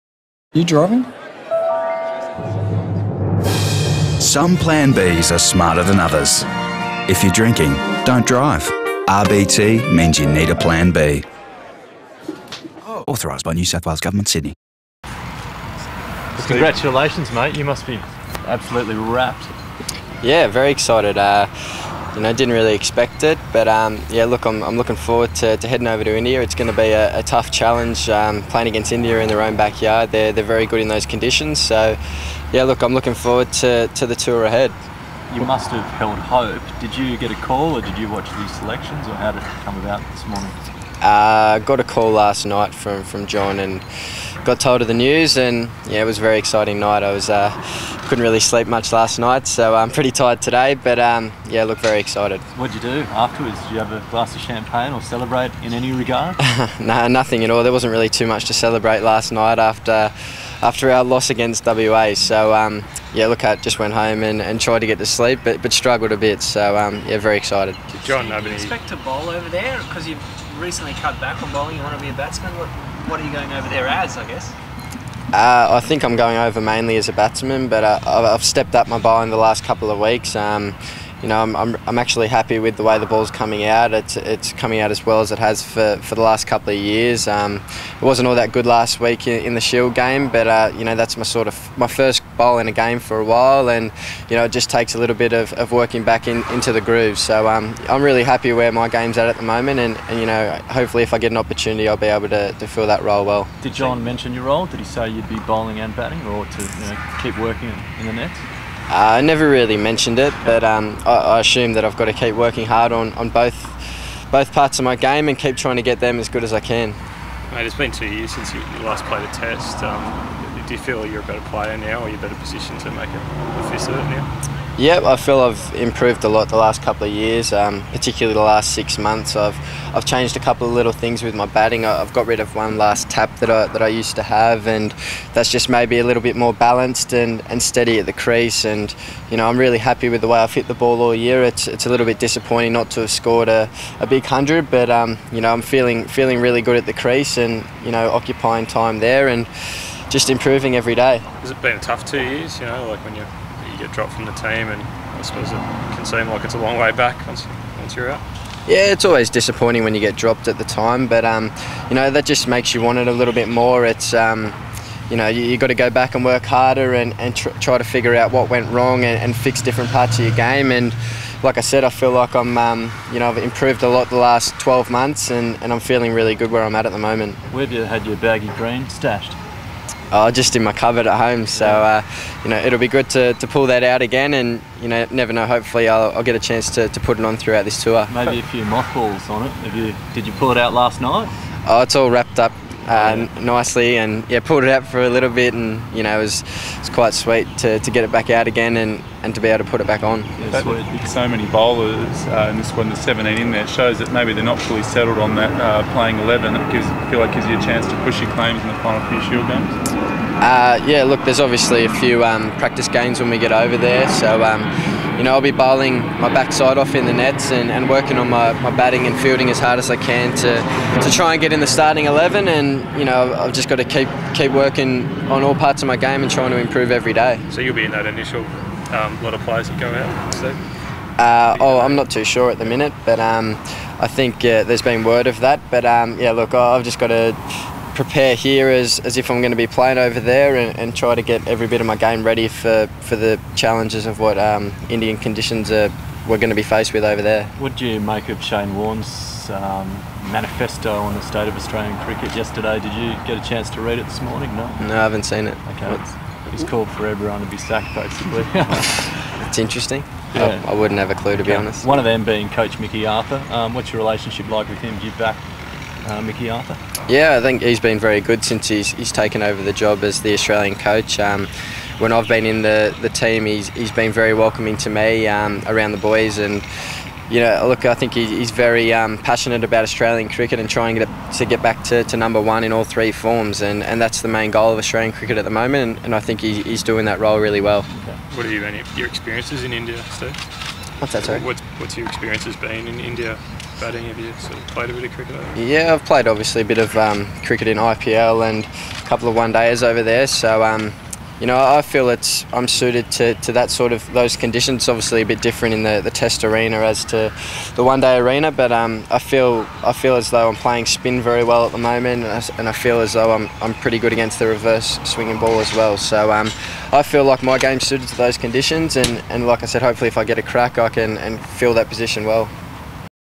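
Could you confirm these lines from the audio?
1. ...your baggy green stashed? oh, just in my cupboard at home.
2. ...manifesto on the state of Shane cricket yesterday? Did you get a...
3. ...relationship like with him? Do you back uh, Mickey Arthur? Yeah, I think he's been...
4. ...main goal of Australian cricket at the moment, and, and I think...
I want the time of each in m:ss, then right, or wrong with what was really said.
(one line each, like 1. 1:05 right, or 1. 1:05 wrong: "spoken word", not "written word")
1. 2:58 right
2. 4:10 wrong: "Australian", not "Shane"
3. 4:24 right
4. 4:44 right.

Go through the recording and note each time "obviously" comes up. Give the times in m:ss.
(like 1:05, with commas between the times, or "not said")
3:31, 4:56, 5:04.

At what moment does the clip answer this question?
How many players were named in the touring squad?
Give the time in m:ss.
3:22.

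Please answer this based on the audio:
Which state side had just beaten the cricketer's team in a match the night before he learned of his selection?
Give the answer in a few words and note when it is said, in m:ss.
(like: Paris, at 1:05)
WA, at 1:01.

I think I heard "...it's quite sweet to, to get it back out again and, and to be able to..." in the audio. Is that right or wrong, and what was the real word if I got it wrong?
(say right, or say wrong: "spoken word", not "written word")
right.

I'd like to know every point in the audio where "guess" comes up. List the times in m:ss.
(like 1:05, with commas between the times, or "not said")
1:14.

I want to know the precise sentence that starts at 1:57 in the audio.
Mate, it's been two years since you, last played a test.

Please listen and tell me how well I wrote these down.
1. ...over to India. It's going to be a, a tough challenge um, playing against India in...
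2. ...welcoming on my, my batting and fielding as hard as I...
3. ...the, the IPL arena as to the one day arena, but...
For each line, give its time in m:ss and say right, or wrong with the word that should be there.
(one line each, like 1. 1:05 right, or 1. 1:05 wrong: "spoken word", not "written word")
1. 0:25 right
2. 3:37 wrong: "working", not "welcoming"
3. 5:05 wrong: "Test", not "IPL".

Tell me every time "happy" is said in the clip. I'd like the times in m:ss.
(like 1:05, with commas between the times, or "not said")
1:22, 1:38, 2:19.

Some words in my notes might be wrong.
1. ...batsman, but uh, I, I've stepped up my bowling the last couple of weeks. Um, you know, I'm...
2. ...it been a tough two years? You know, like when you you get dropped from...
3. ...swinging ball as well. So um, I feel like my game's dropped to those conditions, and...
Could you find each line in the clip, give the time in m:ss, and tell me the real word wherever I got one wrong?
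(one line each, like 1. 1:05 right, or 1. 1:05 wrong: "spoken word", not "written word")
1. 1:17 right
2. 2:31 right
3. 5:15 wrong: "suited", not "dropped".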